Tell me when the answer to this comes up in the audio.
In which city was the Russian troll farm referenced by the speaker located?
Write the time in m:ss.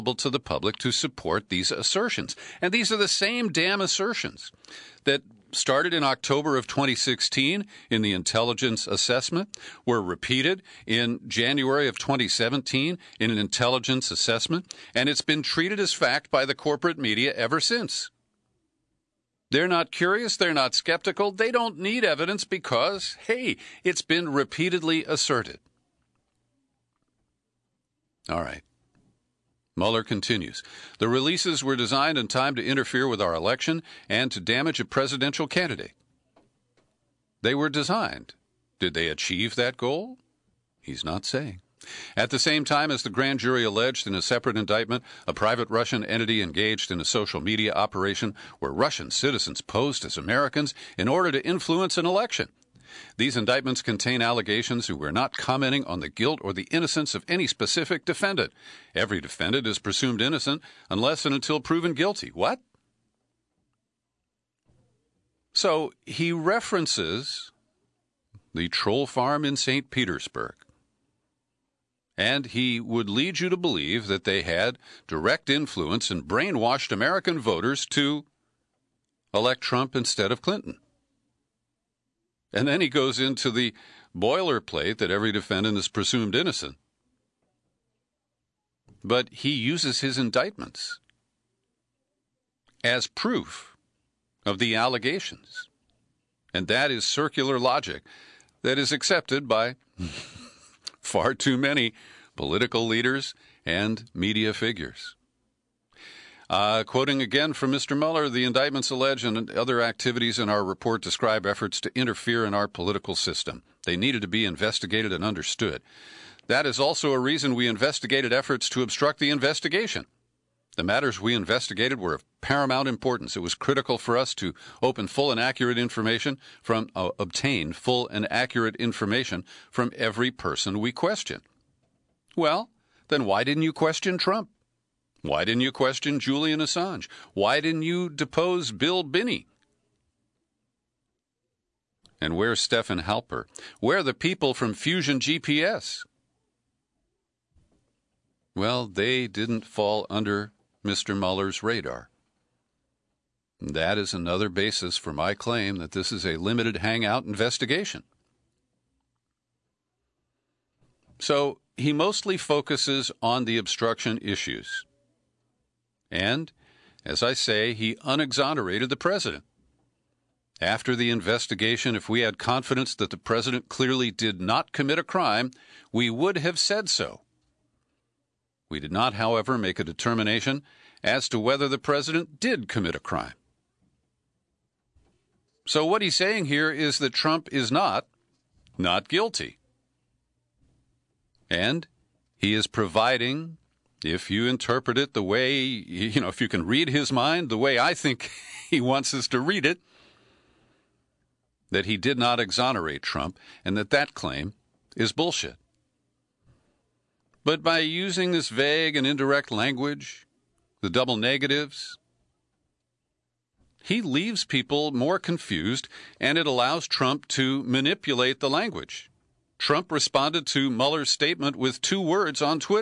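1:09.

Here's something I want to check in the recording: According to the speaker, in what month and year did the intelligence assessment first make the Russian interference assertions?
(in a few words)
October 2016.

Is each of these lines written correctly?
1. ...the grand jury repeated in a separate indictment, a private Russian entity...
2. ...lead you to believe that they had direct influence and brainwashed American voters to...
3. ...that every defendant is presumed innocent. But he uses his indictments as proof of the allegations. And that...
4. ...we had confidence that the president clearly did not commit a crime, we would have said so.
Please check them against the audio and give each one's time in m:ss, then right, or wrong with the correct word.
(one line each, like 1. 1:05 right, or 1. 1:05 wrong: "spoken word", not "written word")
1. 0:43 wrong: "alleged", not "repeated"
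2. 1:13 right
3. 1:24 right
4. 2:52 right.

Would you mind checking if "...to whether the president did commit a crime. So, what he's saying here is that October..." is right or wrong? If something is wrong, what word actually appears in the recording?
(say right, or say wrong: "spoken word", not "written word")
wrong: "Trump", not "October".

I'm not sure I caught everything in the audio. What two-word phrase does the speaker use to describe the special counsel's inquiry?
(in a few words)
limited hangout.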